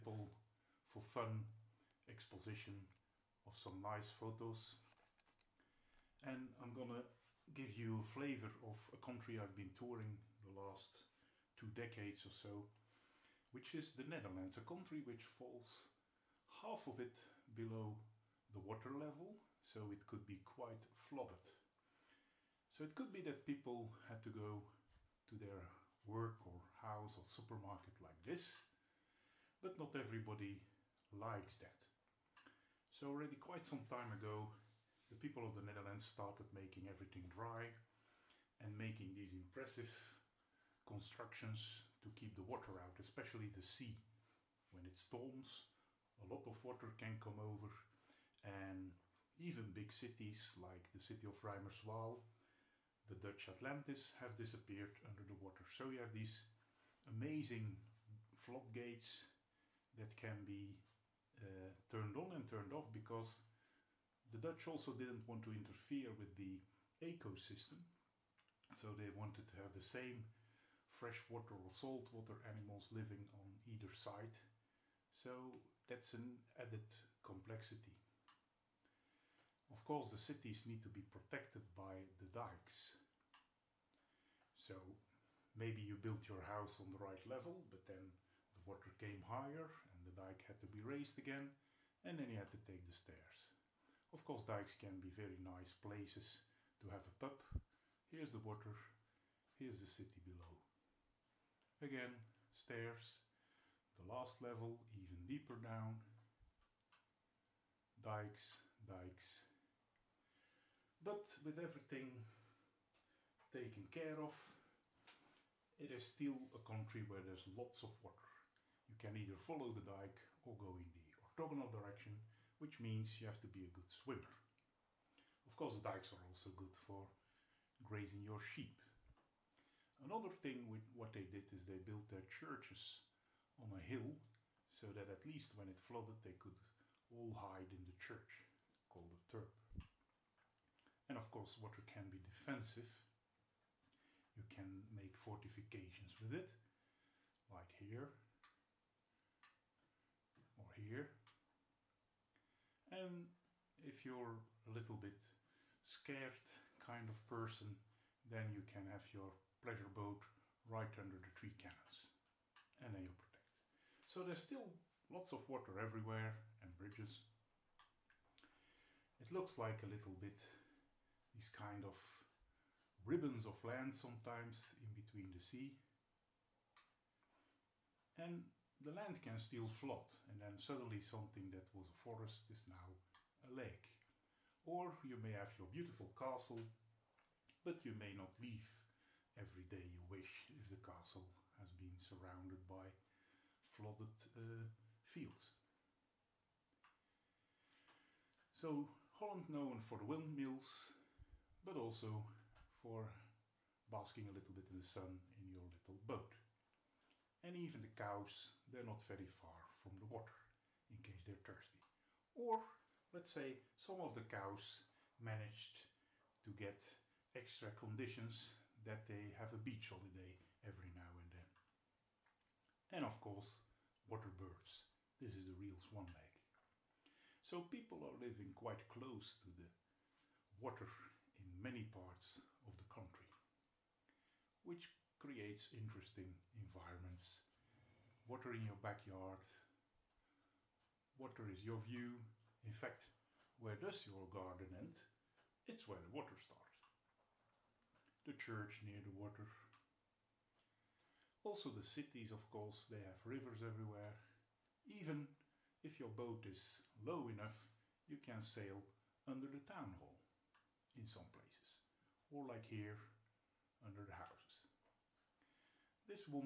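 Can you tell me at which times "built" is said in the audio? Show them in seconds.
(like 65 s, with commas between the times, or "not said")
85 s, 131 s.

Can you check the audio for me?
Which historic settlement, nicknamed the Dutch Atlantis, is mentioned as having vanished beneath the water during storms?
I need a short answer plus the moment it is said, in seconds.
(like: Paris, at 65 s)
Reimerswaal, at 51 s.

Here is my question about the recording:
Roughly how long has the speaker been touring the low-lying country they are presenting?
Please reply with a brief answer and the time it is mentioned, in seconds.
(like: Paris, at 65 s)
two decades, at 11 s.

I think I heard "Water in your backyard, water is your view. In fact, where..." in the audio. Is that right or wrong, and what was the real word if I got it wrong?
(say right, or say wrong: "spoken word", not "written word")
right.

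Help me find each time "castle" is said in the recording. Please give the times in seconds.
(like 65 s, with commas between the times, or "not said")
186 s, 190 s.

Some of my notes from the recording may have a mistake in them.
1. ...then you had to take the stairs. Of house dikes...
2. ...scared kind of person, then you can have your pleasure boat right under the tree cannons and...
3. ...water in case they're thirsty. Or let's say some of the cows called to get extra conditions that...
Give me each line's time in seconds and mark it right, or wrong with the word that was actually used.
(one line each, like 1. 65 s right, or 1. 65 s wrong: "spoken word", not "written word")
1. 92 s wrong: "course", not "house"
2. 155 s right
3. 210 s wrong: "managed", not "called".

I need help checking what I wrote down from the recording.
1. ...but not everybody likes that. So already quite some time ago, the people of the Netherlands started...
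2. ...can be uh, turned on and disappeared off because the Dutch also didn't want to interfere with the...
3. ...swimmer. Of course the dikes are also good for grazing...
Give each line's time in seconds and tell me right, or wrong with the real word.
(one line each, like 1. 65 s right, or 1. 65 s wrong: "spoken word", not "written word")
1. 29 s right
2. 60 s wrong: "turned", not "disappeared"
3. 123 s right.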